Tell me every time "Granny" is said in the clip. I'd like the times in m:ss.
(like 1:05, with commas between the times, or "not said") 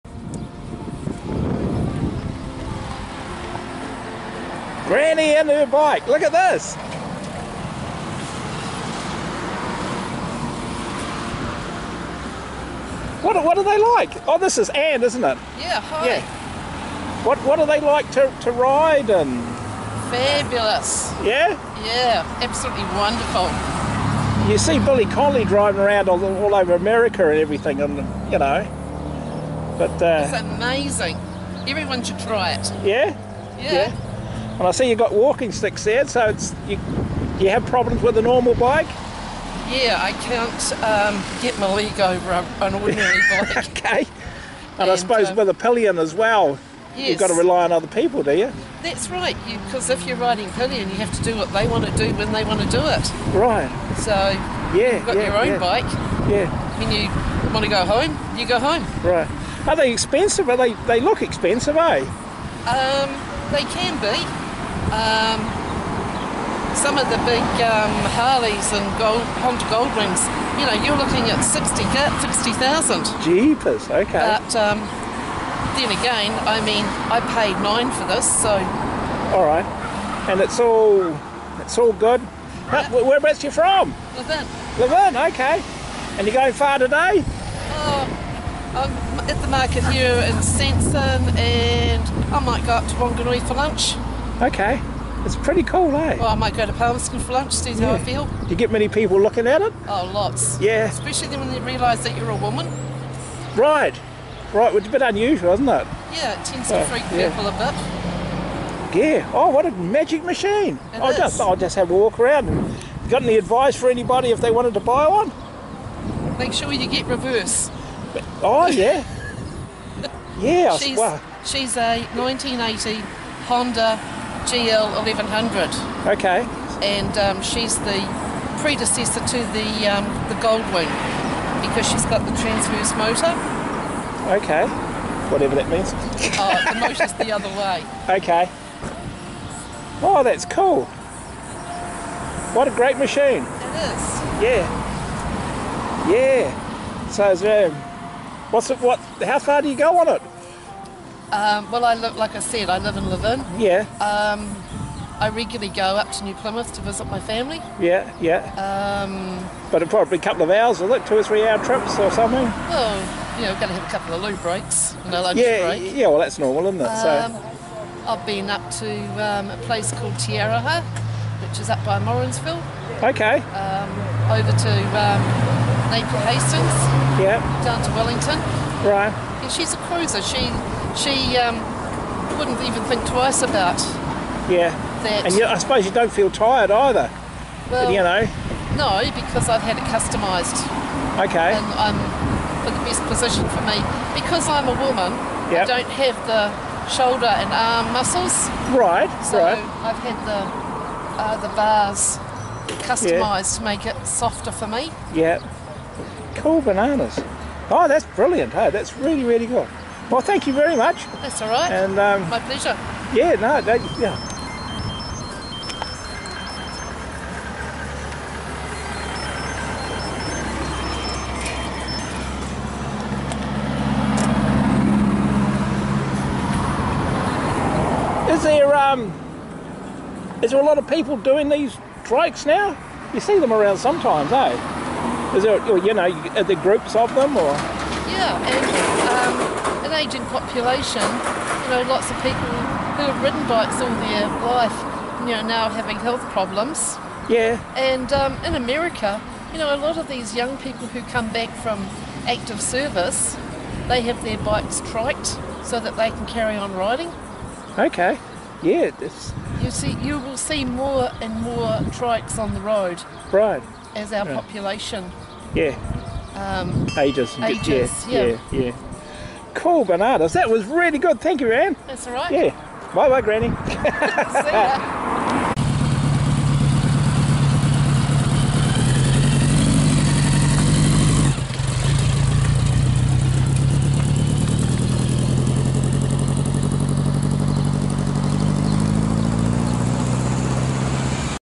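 0:04, 4:33.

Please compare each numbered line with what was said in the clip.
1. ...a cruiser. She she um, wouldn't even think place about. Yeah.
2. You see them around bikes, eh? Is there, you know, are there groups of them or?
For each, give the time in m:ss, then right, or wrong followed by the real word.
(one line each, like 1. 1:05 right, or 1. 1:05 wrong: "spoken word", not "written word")
1. 2:59 wrong: "twice", not "place"
2. 3:53 wrong: "sometimes", not "bikes".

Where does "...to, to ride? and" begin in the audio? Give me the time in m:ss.
0:18.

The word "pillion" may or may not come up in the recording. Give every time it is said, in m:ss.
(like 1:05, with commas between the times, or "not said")
0:45, 0:50.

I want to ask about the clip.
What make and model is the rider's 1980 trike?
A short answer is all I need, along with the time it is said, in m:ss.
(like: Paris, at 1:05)
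Honda GL 1100, at 2:03.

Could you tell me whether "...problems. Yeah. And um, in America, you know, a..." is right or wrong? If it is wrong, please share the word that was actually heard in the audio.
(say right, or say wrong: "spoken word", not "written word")
right.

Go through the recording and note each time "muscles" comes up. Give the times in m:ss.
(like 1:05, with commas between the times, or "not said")
3:17.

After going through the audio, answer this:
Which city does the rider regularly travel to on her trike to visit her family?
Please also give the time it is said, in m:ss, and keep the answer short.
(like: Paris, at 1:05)
New Plymouth, at 2:36.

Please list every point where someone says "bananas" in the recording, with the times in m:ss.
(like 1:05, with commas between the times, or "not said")
3:26, 4:29.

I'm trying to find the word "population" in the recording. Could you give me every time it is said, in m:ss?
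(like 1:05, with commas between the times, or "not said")
4:00, 4:24.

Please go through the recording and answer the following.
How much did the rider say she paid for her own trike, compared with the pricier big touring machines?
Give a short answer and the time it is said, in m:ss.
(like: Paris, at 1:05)
9,000, at 1:17.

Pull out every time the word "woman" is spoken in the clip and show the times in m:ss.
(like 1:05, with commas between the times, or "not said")
1:42, 3:14.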